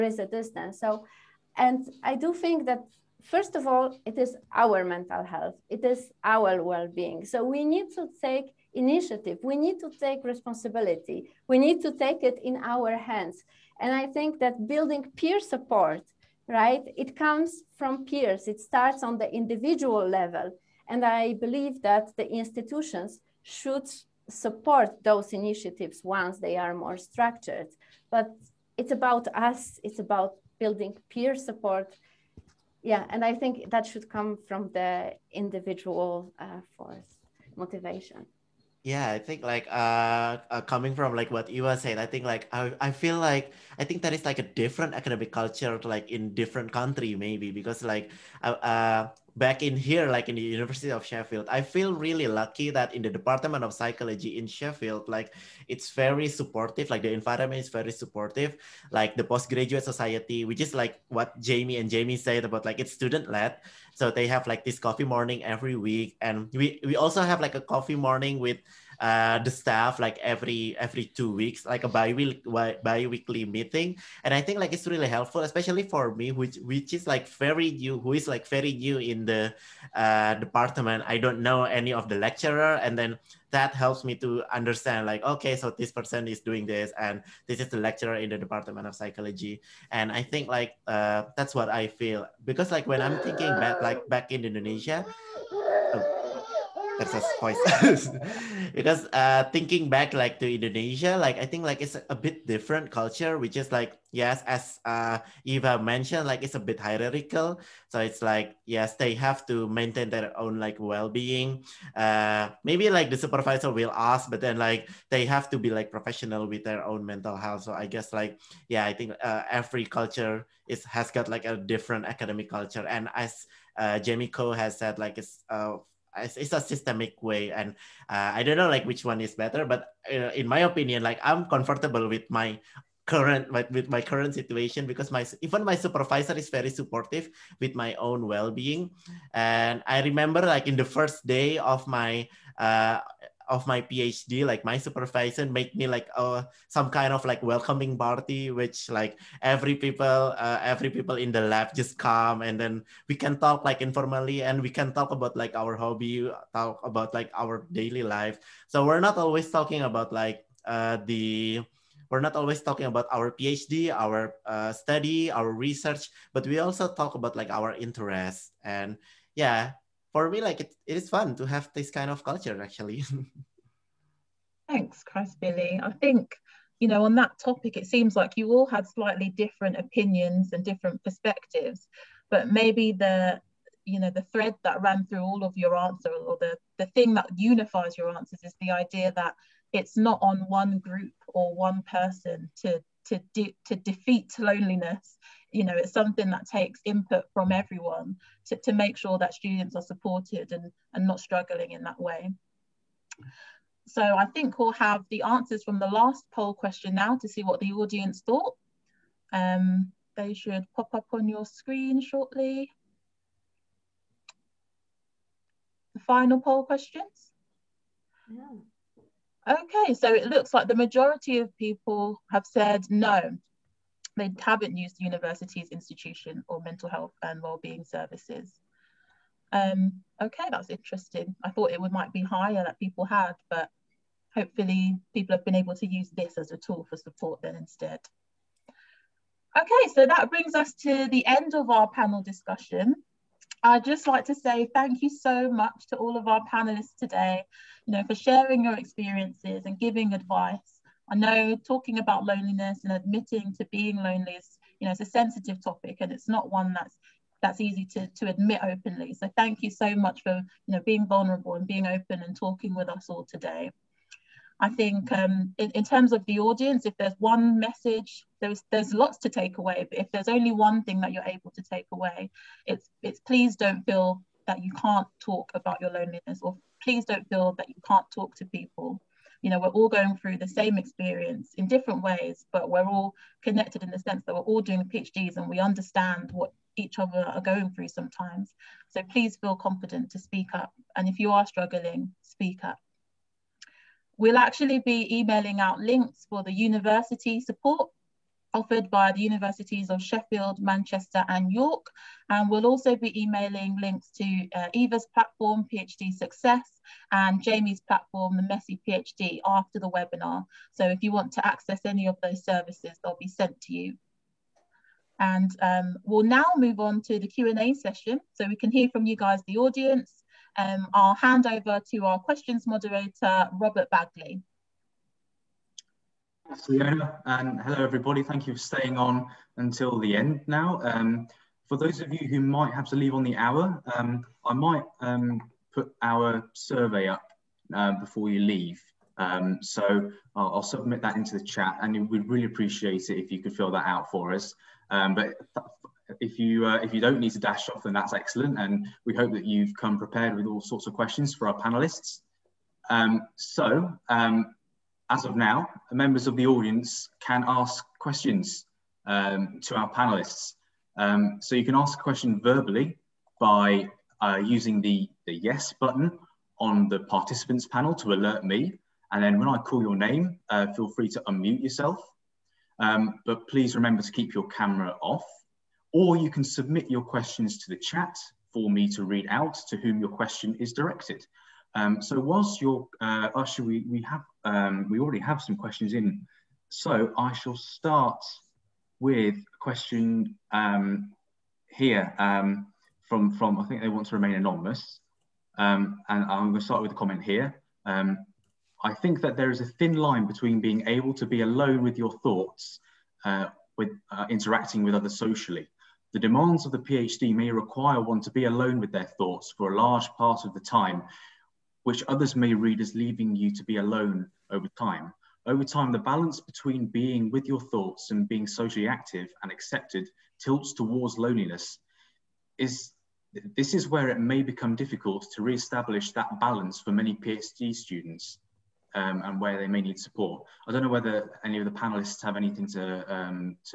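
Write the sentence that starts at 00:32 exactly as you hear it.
Yeah, and I think that should come from the individual uh, force motivation.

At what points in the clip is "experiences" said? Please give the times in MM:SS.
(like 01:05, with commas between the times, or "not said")
04:08, 04:40.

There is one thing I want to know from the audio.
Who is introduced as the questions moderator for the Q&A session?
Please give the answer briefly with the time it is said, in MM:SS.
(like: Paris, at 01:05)
Robert Bagley, at 05:23.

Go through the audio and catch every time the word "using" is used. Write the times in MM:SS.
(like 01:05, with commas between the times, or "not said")
06:04.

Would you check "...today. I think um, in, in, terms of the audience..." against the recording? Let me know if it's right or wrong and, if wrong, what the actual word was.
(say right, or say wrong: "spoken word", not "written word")
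right.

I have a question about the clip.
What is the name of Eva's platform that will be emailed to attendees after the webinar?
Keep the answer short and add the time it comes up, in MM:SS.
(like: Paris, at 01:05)
PhD Success, at 05:05.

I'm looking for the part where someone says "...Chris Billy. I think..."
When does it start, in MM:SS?
02:55.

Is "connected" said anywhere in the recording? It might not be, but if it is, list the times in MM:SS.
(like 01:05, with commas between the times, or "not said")
04:43.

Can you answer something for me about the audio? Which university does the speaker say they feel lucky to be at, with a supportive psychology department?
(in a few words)
University of Sheffield.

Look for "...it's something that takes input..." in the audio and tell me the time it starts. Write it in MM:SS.
03:15.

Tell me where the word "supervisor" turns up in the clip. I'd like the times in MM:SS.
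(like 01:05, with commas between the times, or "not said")
01:53, 02:15, 02:24.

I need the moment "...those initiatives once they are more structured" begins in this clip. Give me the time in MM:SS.
00:25.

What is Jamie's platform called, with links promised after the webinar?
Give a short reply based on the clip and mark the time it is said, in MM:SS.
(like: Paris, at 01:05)
The Messy PhD, at 05:08.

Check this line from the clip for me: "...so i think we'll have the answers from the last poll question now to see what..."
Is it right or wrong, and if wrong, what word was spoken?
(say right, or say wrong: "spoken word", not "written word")
right.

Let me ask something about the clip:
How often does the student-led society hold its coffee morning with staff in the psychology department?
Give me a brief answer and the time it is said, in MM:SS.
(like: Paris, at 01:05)
Every two weeks, at 01:10.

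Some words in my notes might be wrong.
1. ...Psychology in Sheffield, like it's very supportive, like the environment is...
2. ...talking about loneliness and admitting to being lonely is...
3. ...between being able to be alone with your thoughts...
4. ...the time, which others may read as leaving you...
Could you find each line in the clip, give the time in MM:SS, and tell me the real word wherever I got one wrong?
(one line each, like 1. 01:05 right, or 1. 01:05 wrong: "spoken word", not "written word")
1. 00:53 right
2. 04:11 right
3. 06:40 right
4. 06:50 right.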